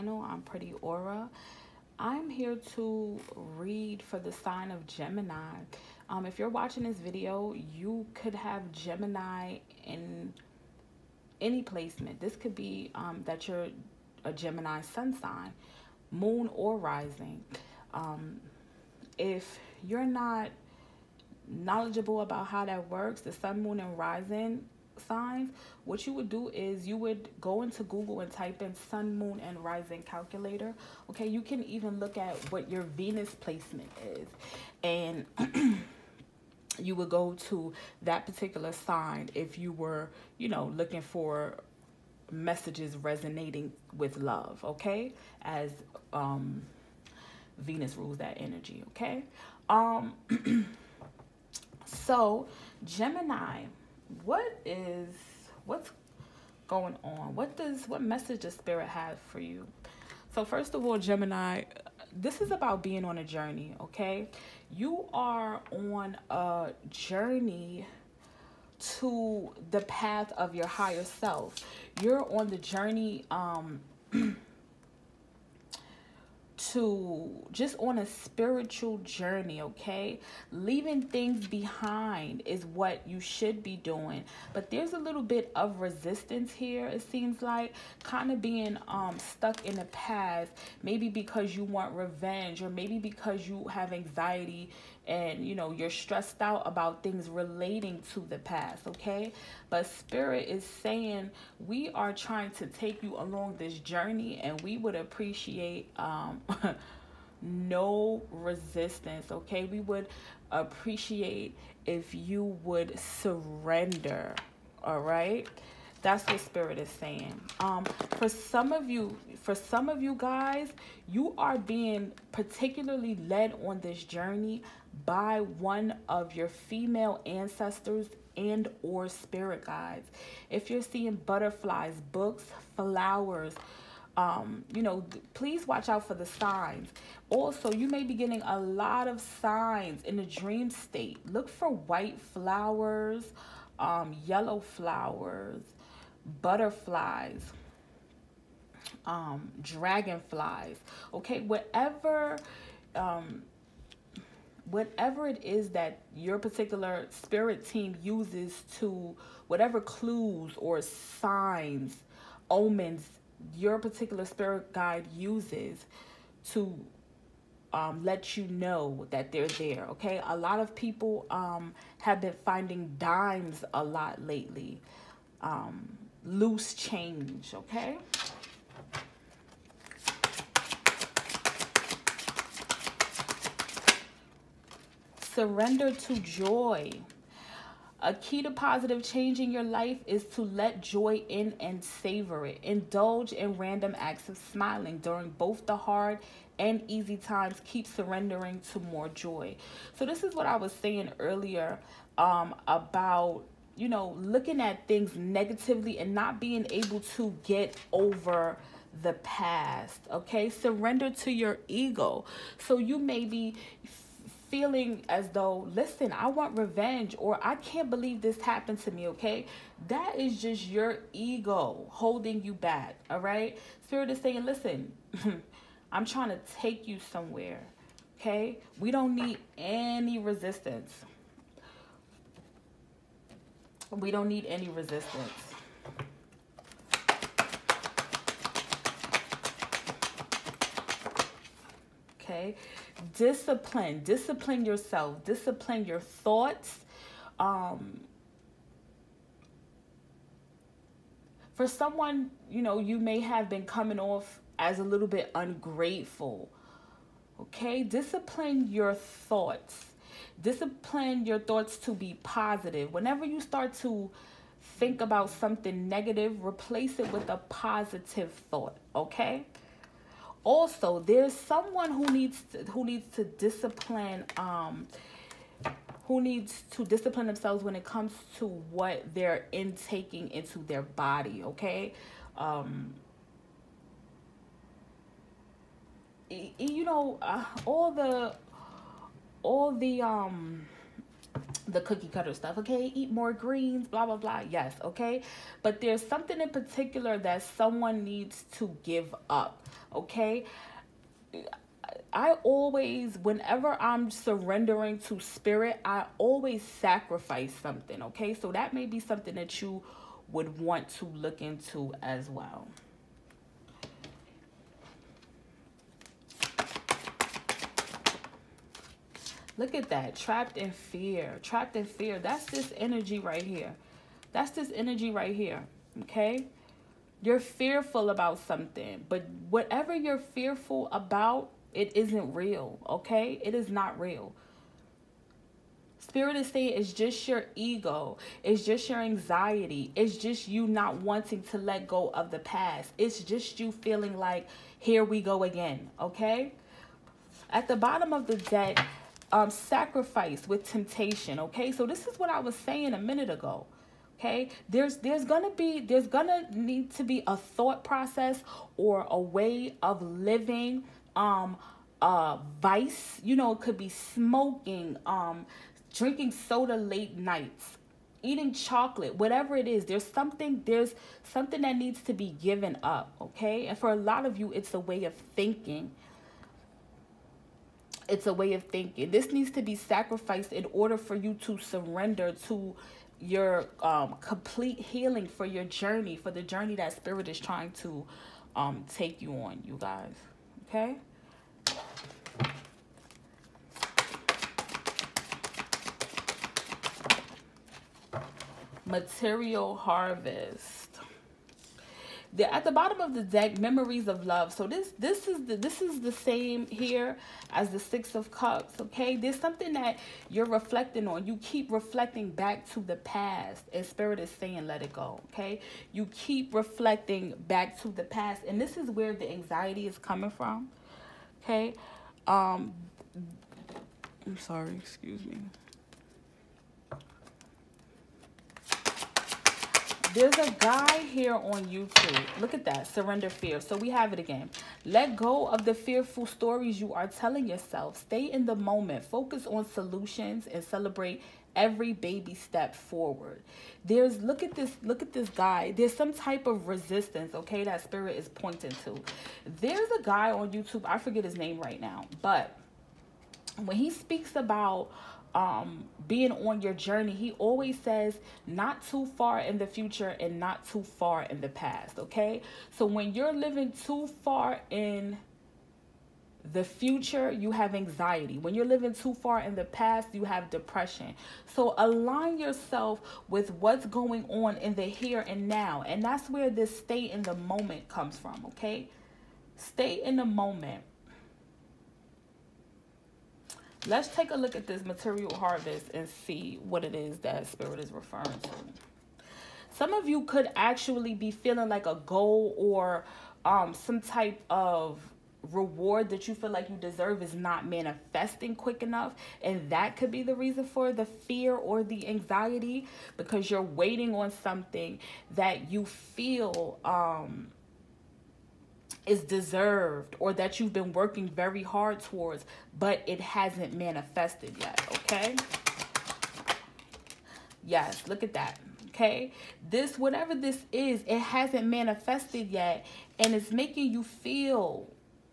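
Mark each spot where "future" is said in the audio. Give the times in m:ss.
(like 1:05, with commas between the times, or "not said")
7:39, 7:46.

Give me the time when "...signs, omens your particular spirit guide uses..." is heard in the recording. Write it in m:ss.
2:40.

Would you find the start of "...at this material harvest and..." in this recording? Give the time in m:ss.
8:04.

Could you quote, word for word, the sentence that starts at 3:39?
That is just your ego holding you back, all right?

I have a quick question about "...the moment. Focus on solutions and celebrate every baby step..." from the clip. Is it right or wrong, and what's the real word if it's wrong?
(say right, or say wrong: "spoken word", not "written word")
right.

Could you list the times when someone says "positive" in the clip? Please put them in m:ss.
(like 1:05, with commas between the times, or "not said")
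3:08, 4:22, 4:27.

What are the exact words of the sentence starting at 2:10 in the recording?
If you're seeing butterflies, books, flowers, um, you know, please watch out for the signs.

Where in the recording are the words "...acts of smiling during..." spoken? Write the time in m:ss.
3:13.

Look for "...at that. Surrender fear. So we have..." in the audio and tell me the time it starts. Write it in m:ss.
7:12.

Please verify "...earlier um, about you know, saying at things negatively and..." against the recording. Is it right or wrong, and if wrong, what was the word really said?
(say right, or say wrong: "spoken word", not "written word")
wrong: "looking", not "saying".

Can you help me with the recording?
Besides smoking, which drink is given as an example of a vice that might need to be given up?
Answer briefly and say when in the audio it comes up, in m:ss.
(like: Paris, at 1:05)
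Soda, at 6:05.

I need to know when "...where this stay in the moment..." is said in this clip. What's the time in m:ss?
7:56.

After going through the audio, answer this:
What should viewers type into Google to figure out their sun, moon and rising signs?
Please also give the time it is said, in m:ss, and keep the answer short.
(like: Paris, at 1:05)
sun, moon, and rising calculator, at 0:28.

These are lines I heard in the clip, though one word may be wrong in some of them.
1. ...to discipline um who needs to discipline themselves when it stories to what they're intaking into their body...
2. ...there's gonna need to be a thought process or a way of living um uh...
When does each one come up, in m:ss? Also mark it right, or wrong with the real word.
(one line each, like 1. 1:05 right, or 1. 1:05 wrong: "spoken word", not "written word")
1. 4:33 wrong: "comes", not "stories"
2. 5:55 right.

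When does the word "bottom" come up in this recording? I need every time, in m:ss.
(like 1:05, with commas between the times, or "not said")
5:47, 6:42.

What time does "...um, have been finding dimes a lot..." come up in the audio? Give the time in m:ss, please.
2:51.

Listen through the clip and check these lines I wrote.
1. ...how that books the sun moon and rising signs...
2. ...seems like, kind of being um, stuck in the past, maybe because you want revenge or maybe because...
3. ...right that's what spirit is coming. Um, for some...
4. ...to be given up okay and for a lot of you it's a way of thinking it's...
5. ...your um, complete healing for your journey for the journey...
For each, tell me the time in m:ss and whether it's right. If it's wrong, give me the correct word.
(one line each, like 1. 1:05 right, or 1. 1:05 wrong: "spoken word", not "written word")
1. 0:22 wrong: "works", not "books"
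2. 1:27 right
3. 1:54 wrong: "saying", not "coming"
4. 6:12 right
5. 6:23 right.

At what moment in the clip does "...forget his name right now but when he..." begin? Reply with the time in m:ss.
7:30.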